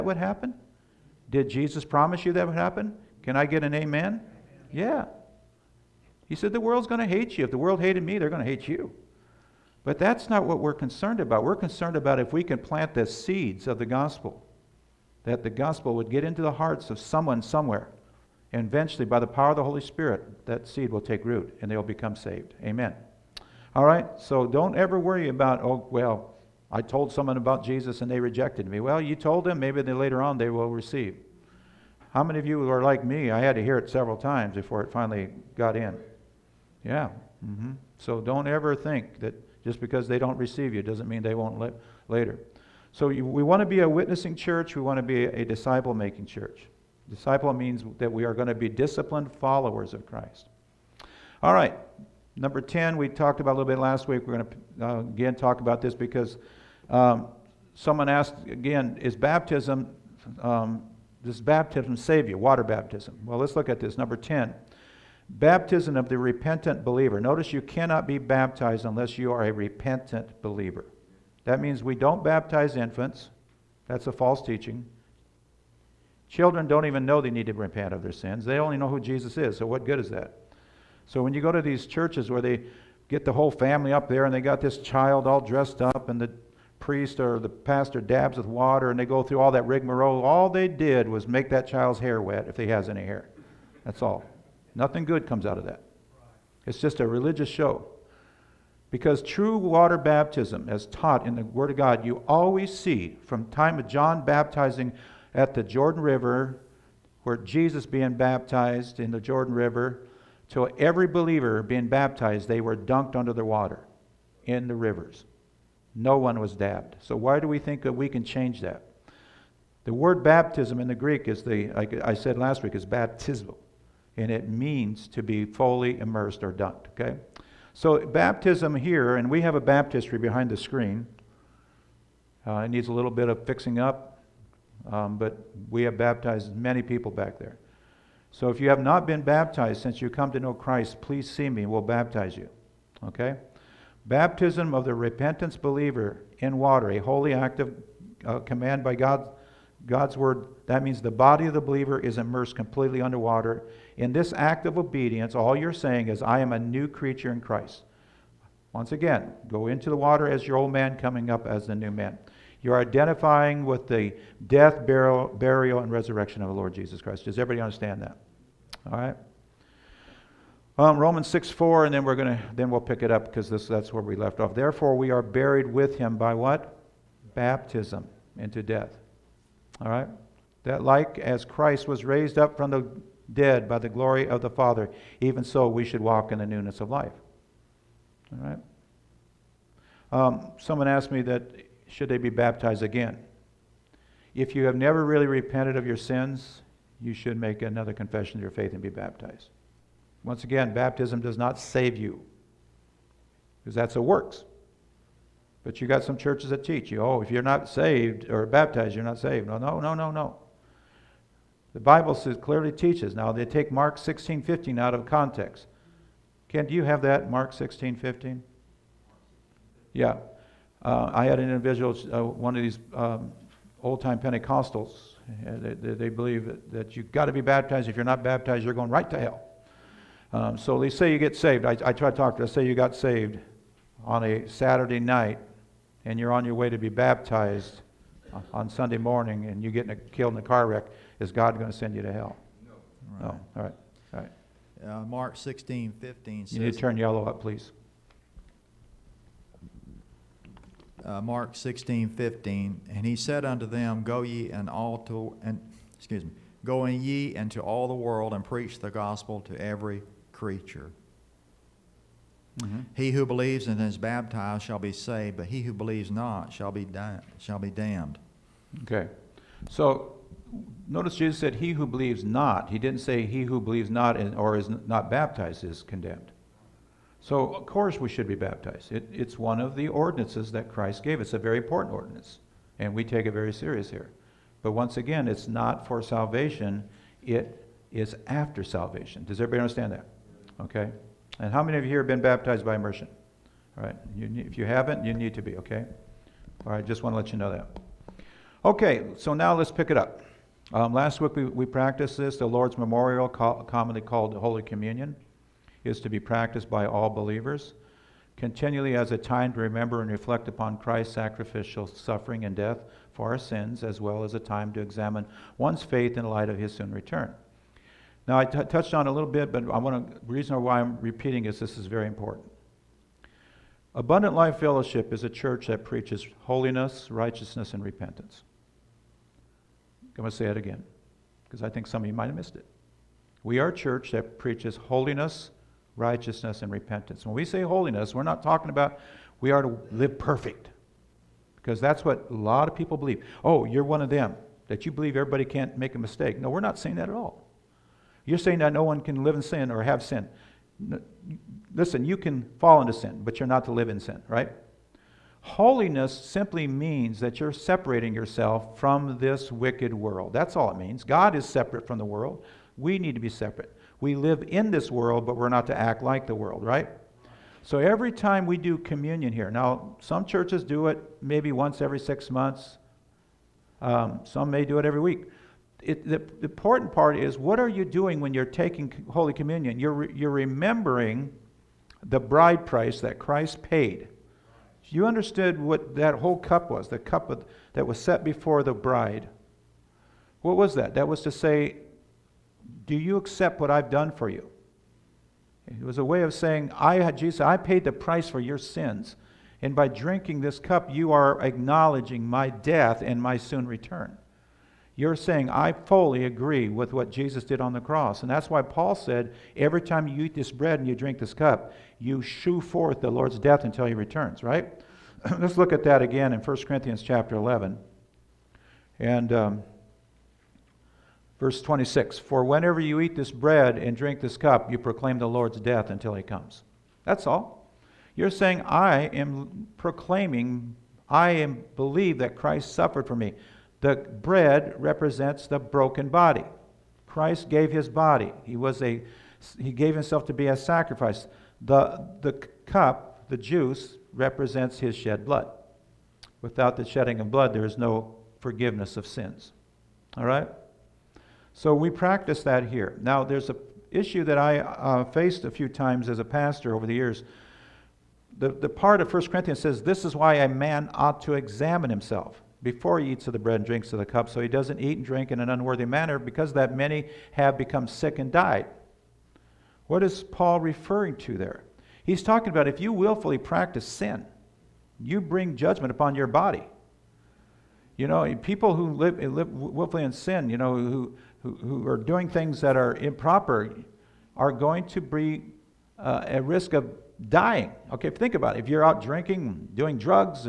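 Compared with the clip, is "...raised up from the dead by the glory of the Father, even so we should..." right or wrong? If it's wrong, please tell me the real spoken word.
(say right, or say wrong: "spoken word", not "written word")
right.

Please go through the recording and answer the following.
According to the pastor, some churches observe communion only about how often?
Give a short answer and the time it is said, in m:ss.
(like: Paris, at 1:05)
Once every six months, at 6:11.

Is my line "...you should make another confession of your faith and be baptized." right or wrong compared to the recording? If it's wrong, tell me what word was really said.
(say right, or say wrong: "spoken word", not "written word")
right.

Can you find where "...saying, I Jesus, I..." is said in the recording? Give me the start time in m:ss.
6:36.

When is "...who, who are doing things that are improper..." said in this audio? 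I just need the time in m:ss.
8:01.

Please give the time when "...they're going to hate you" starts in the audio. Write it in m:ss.
0:08.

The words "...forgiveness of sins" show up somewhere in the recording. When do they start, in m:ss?
7:28.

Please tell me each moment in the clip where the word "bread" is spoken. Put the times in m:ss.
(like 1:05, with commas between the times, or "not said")
6:50, 7:03, 7:13, 7:43.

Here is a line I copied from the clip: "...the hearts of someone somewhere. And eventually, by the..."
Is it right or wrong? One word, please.
right.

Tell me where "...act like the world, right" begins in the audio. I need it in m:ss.
6:05.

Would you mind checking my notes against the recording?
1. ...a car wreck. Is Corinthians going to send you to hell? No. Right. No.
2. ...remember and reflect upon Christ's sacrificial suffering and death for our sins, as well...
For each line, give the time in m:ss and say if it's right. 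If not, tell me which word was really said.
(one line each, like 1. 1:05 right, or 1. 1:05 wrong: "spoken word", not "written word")
1. 4:00 wrong: "God", not "Corinthians"
2. 5:09 right.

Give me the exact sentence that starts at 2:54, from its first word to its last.
Therefore we are buried with him by what?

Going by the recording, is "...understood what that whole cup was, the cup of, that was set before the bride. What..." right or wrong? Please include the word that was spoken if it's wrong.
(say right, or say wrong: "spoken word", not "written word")
right.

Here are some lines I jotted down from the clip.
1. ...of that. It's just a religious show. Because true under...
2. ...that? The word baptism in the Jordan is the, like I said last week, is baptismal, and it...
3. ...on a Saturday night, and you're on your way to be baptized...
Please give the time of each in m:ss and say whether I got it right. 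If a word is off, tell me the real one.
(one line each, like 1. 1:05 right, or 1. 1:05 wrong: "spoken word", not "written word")
1. 1:35 wrong: "water", not "under"
2. 1:58 wrong: "Greek", not "Jordan"
3. 3:54 right.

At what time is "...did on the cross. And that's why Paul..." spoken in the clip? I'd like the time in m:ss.
6:47.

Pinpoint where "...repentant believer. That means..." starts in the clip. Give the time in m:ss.
1:09.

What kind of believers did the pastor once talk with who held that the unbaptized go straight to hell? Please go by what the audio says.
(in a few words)
Old time Pentecostals.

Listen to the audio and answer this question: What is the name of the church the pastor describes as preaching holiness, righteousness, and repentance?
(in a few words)
Abundant Life Fellowship.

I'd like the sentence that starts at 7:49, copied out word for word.
What is Paul referring to there?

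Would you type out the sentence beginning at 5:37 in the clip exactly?
When we say holiness, we're not talking about we are to live perfect because that's what a lot of people believe.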